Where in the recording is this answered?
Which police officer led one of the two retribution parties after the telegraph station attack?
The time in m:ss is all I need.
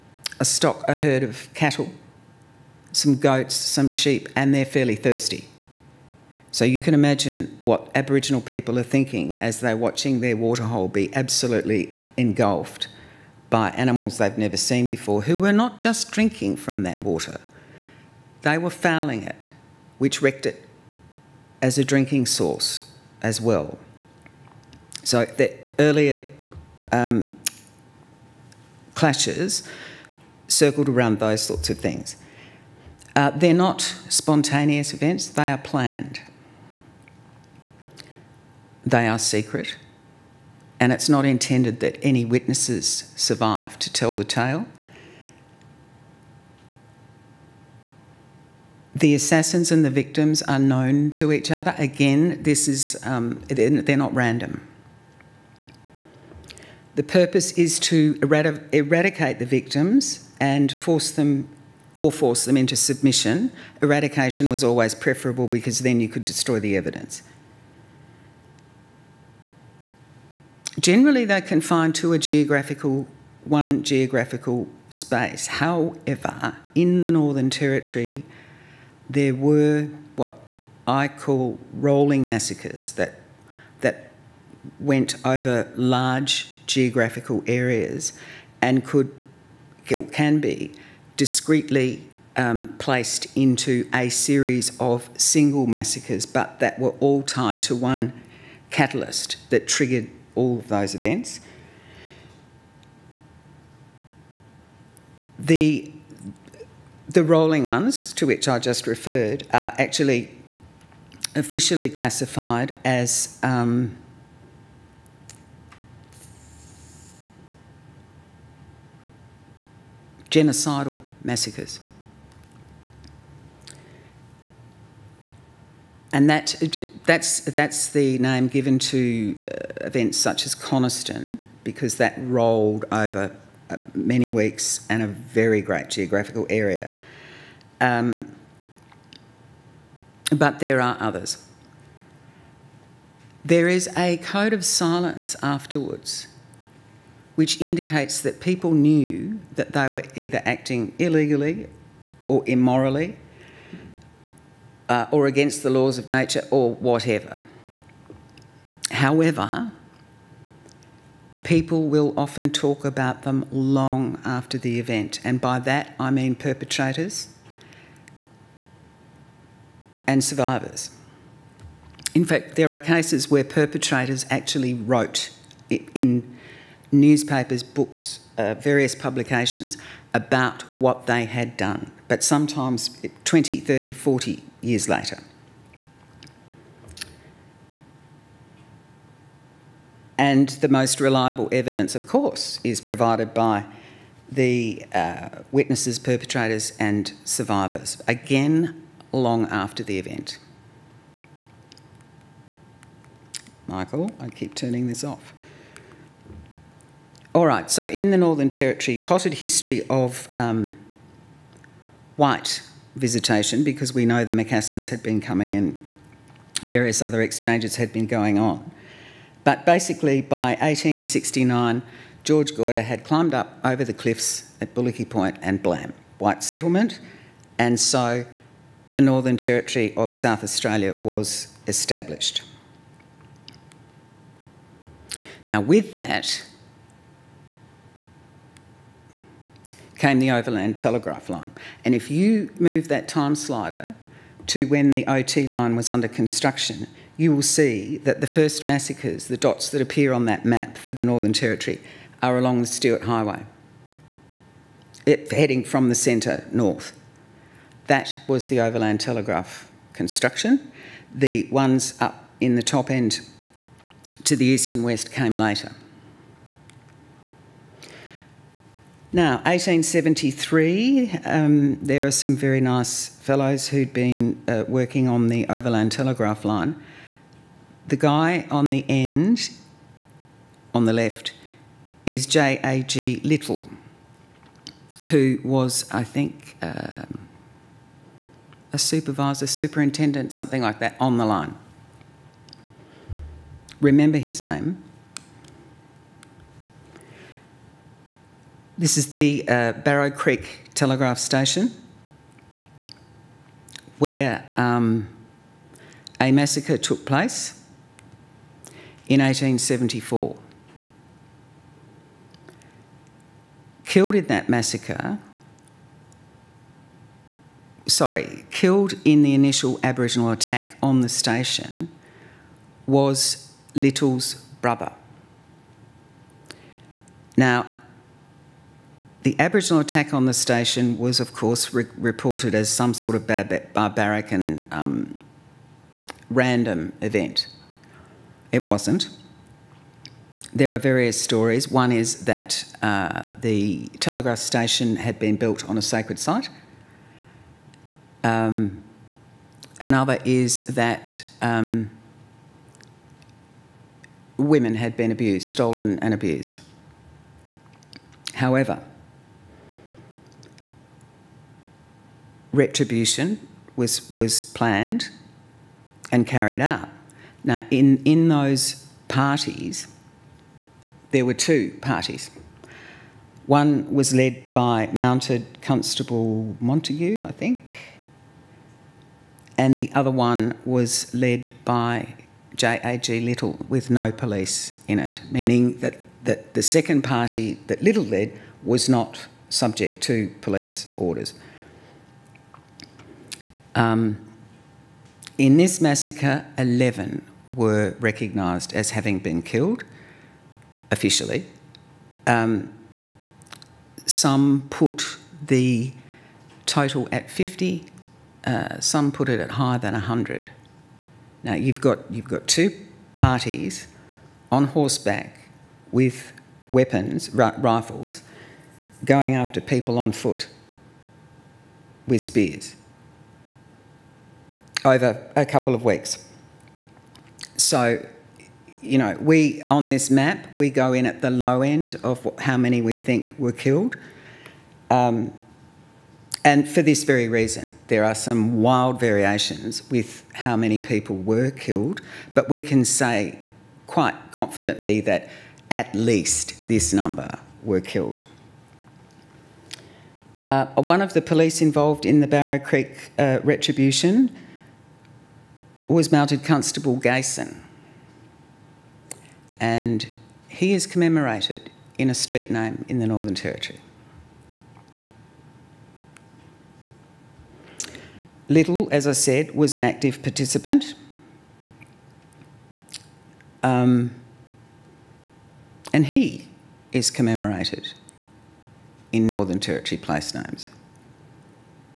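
6:14.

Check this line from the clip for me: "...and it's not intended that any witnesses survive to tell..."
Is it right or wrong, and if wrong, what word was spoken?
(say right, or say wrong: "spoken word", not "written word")
right.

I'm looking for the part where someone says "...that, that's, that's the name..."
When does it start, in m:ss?
2:06.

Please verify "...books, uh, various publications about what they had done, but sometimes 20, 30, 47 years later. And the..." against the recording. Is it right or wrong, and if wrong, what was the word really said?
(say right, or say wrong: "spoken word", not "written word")
wrong: "40", not "47".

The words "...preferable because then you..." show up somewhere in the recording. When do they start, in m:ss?
1:04.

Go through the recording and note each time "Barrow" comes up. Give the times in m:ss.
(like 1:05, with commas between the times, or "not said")
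4:59, 7:32.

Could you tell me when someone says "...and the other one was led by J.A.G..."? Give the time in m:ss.
6:19.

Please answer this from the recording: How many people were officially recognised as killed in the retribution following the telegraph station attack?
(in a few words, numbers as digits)
11.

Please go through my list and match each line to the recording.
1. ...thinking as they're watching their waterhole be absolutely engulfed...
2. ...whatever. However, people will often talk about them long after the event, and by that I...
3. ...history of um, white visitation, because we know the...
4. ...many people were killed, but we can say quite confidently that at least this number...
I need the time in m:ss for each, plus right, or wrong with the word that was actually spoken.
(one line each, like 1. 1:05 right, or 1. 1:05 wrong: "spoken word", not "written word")
1. 0:08 right
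2. 2:36 right
3. 3:29 right
4. 7:20 right.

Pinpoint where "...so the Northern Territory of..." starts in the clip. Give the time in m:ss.
3:47.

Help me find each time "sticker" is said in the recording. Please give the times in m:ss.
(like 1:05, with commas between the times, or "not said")
not said.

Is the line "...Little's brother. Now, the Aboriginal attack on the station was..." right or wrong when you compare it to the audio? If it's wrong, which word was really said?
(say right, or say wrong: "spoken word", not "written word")
right.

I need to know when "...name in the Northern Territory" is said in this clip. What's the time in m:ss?
7:42.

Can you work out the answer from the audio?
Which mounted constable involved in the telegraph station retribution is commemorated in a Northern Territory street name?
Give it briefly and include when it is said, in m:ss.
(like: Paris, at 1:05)
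Gason, at 7:36.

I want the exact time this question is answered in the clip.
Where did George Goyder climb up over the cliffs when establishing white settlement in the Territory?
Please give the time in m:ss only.
3:44.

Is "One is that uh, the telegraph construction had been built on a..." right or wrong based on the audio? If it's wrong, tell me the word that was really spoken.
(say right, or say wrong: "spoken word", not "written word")
wrong: "station", not "construction".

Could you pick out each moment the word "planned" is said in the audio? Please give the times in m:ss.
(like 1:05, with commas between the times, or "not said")
0:35, 6:04.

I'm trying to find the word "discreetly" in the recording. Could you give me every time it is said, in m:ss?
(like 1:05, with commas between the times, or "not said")
1:31.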